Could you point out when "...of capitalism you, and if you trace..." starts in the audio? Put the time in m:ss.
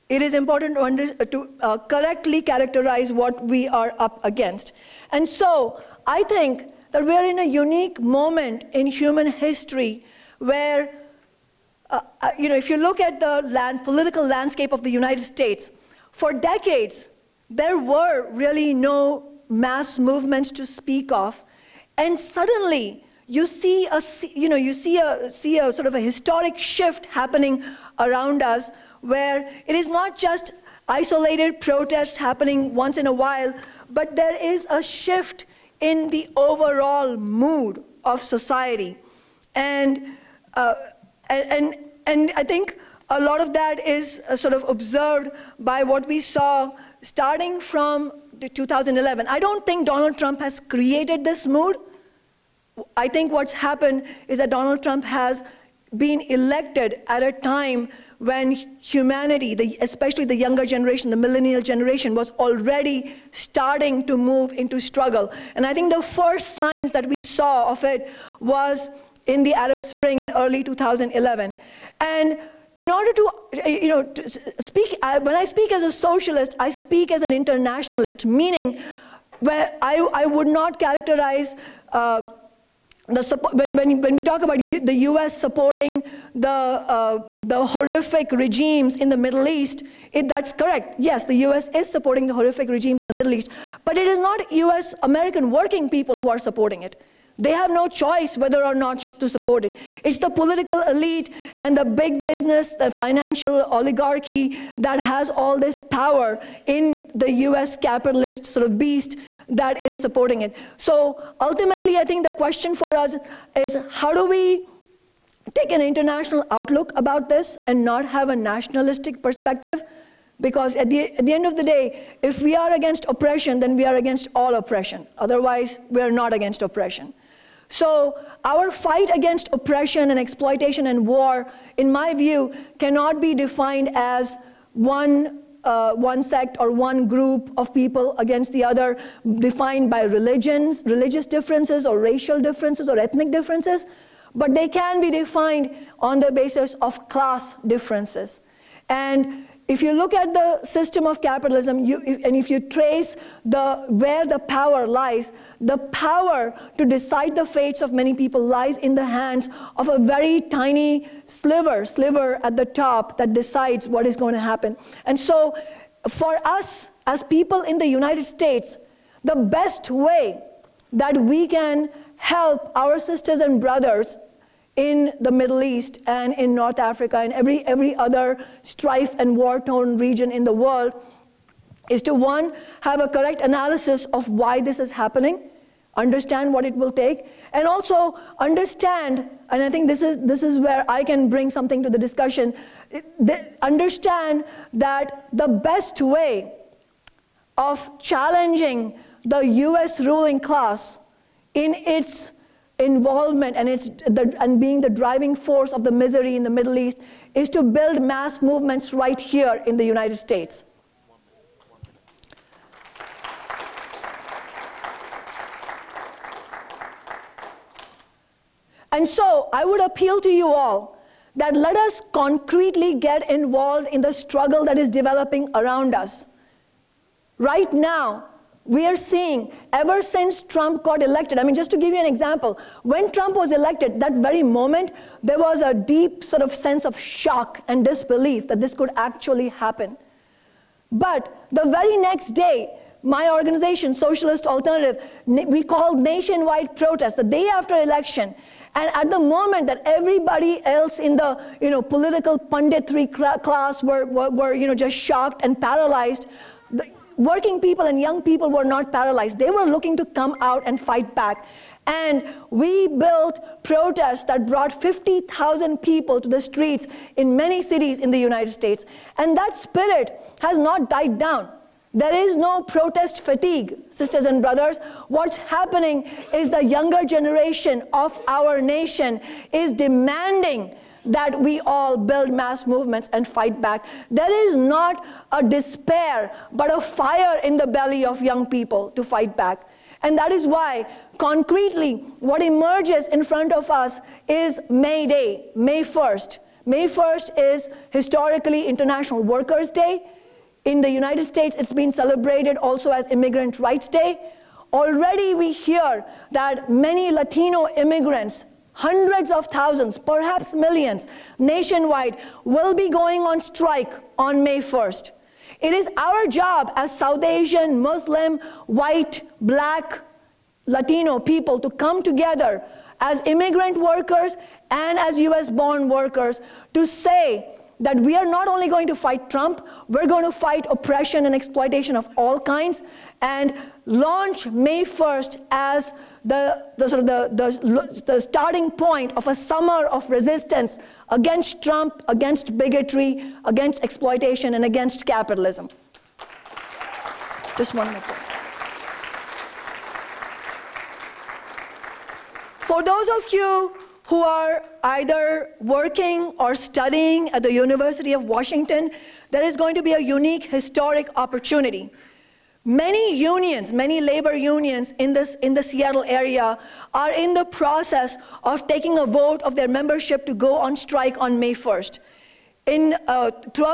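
2:31.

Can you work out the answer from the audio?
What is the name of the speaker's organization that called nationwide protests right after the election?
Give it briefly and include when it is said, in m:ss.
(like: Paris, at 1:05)
Socialist Alternative, at 4:03.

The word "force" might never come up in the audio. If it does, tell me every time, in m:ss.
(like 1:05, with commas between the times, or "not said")
3:25.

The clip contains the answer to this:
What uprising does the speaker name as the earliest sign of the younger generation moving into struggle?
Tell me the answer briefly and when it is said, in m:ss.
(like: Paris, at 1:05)
Arab Spring, at 1:09.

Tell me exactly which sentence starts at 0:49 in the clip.
I don't think Donald Trump has created this mood.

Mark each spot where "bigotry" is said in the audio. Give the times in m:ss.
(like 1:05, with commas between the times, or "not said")
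5:42.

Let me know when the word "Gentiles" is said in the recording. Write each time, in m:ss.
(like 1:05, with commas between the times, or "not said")
not said.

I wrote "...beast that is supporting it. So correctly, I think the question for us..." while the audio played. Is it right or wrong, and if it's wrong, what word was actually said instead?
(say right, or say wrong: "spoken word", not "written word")
wrong: "ultimately", not "correctly".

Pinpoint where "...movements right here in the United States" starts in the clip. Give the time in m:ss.
3:28.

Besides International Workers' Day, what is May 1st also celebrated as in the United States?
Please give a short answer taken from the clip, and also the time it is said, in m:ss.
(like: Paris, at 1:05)
Immigrant Rights Day, at 5:03.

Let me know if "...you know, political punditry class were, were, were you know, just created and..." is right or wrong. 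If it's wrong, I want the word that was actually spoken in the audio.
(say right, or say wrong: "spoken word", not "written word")
wrong: "shocked", not "created".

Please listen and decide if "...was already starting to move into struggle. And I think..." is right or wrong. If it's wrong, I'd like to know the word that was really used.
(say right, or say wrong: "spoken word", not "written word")
right.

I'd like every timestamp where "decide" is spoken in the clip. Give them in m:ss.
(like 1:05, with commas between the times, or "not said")
2:36, 2:43.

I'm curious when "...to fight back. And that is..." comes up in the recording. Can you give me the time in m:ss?
4:48.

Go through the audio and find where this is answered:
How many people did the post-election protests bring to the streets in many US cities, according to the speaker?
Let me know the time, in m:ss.
4:24.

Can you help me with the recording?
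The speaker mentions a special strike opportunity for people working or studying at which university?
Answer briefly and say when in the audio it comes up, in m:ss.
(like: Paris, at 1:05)
University of Washington, at 5:57.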